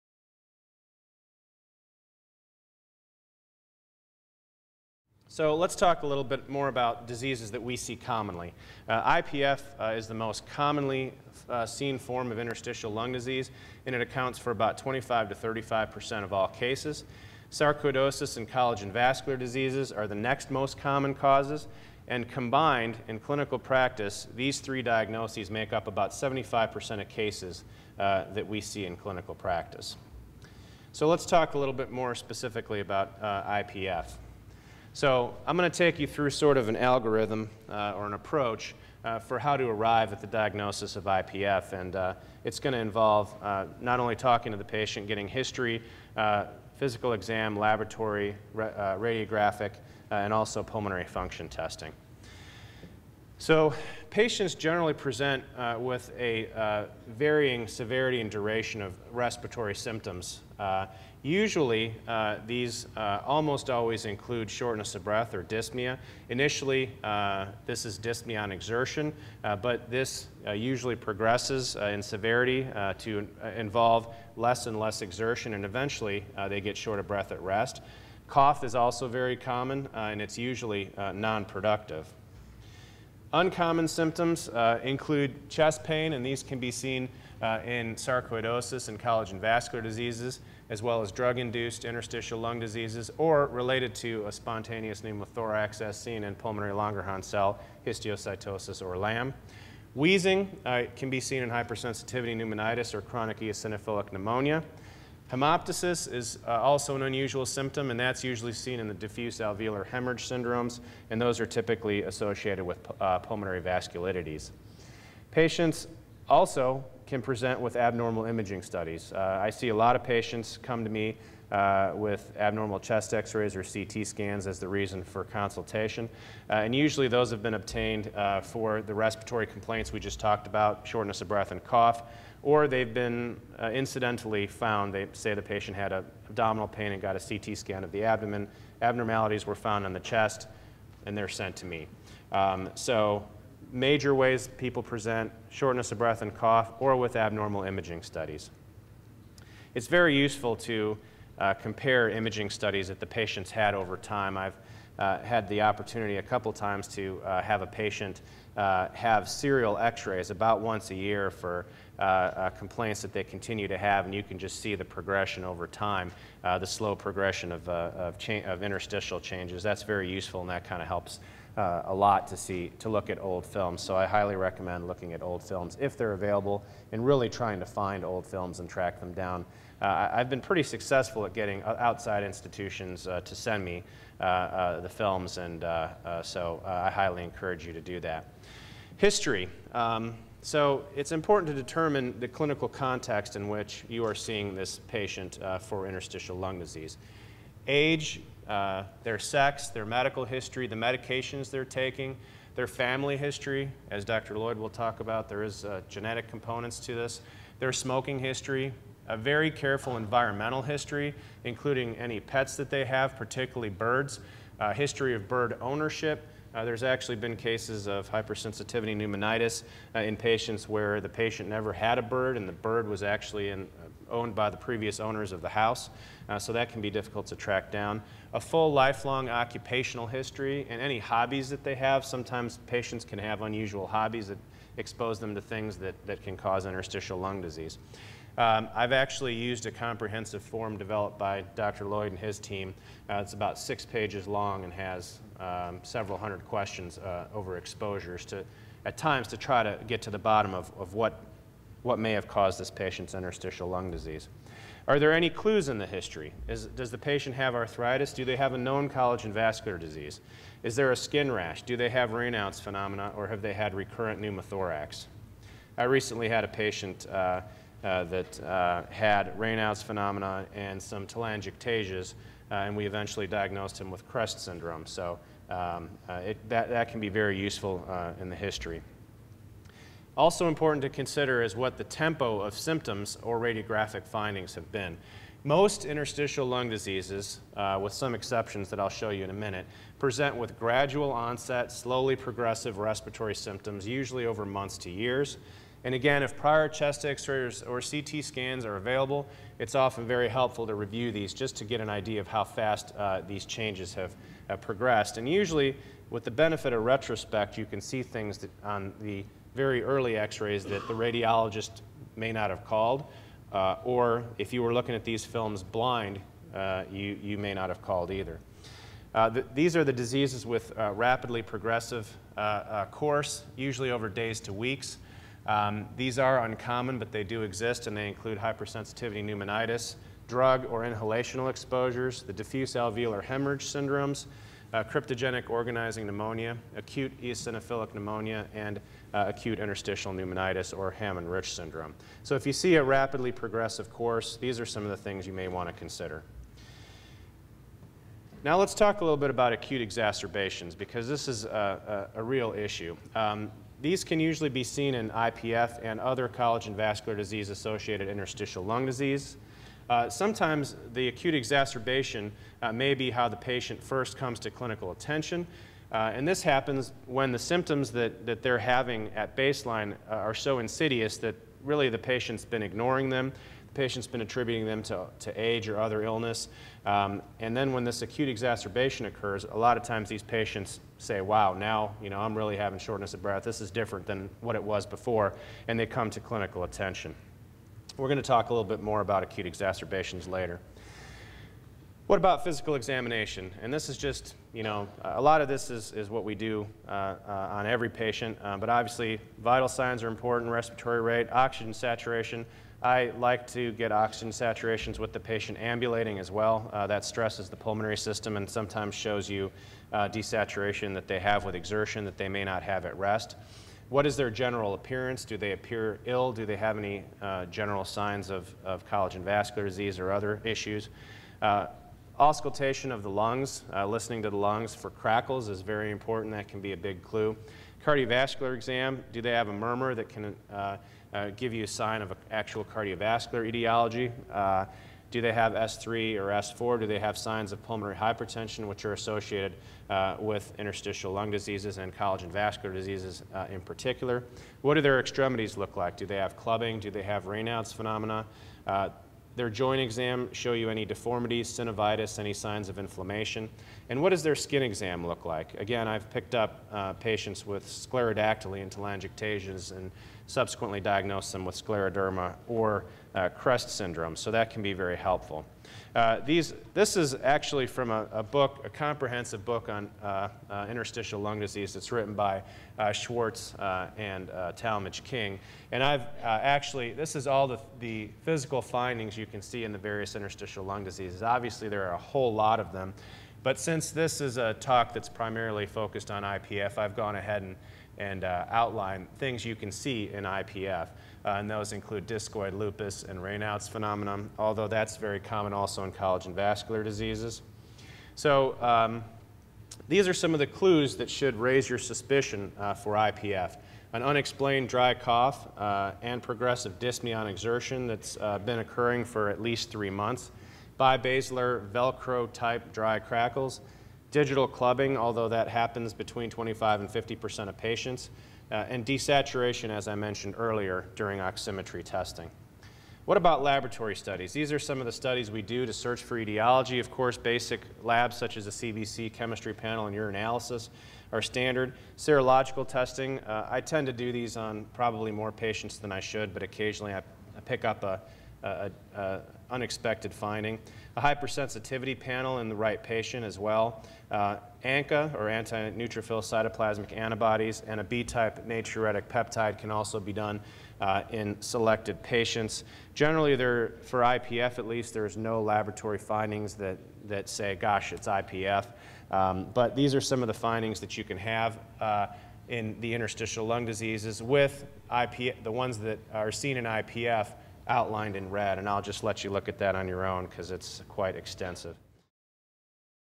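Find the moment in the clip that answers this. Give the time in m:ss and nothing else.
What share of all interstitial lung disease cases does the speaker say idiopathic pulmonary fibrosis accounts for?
0:14.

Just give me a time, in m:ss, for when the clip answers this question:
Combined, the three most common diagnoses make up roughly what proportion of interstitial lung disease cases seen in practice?
0:26.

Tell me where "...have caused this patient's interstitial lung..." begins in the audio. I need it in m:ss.
4:12.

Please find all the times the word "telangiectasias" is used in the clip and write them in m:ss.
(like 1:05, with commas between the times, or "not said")
4:31, 7:38.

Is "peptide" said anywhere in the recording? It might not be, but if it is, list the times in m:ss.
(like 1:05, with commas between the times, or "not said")
9:09.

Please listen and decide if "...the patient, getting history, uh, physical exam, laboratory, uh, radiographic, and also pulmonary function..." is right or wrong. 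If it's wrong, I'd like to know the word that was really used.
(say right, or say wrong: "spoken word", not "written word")
right.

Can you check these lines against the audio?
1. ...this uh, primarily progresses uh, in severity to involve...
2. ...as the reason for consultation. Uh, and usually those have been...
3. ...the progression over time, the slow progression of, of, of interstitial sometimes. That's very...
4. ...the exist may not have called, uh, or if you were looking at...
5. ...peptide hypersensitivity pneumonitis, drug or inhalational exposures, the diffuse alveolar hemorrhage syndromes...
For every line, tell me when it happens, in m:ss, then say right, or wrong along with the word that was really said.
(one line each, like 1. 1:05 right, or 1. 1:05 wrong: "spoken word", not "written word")
1. 1:09 wrong: "usually", not "primarily"
2. 2:04 right
3. 2:44 wrong: "changes", not "sometimes"
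4. 5:10 wrong: "radiologist", not "exist"
5. 5:28 wrong: "include", not "peptide".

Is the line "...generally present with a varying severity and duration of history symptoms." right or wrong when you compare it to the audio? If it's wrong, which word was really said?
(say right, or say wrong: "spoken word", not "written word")
wrong: "respiratory", not "history".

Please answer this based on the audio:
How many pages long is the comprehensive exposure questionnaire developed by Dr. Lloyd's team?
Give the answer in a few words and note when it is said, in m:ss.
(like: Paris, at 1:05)
6, at 4:03.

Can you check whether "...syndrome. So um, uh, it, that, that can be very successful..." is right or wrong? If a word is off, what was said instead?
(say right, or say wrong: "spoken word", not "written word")
wrong: "useful", not "successful".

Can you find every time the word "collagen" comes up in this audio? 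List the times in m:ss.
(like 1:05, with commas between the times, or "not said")
0:18, 1:28, 4:18, 5:56, 6:58, 7:21, 8:15.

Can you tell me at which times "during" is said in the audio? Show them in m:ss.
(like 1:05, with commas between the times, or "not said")
8:40.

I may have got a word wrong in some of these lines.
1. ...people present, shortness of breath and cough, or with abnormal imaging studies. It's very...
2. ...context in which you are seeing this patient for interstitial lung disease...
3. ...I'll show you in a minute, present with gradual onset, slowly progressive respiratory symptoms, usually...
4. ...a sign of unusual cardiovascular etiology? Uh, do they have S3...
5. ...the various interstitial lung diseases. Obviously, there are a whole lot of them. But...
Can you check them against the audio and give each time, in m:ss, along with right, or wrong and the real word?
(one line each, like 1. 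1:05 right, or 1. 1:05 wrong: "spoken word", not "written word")
1. 2:24 right
2. 3:12 right
3. 4:48 right
4. 7:11 wrong: "actual", not "unusual"
5. 7:59 right.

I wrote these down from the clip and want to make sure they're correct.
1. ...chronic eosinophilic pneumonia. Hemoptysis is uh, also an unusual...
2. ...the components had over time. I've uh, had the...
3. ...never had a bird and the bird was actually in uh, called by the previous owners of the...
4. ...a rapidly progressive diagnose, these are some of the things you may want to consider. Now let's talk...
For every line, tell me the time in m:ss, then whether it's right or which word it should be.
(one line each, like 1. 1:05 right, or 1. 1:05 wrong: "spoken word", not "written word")
1. 1:43 right
2. 2:32 wrong: "patients", not "components"
3. 3:41 wrong: "owned", not "called"
4. 5:42 wrong: "course", not "diagnose".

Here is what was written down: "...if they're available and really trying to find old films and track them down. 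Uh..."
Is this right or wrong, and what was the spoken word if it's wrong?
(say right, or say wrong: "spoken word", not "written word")
right.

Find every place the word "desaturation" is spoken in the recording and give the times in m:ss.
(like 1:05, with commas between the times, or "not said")
6:50, 8:38.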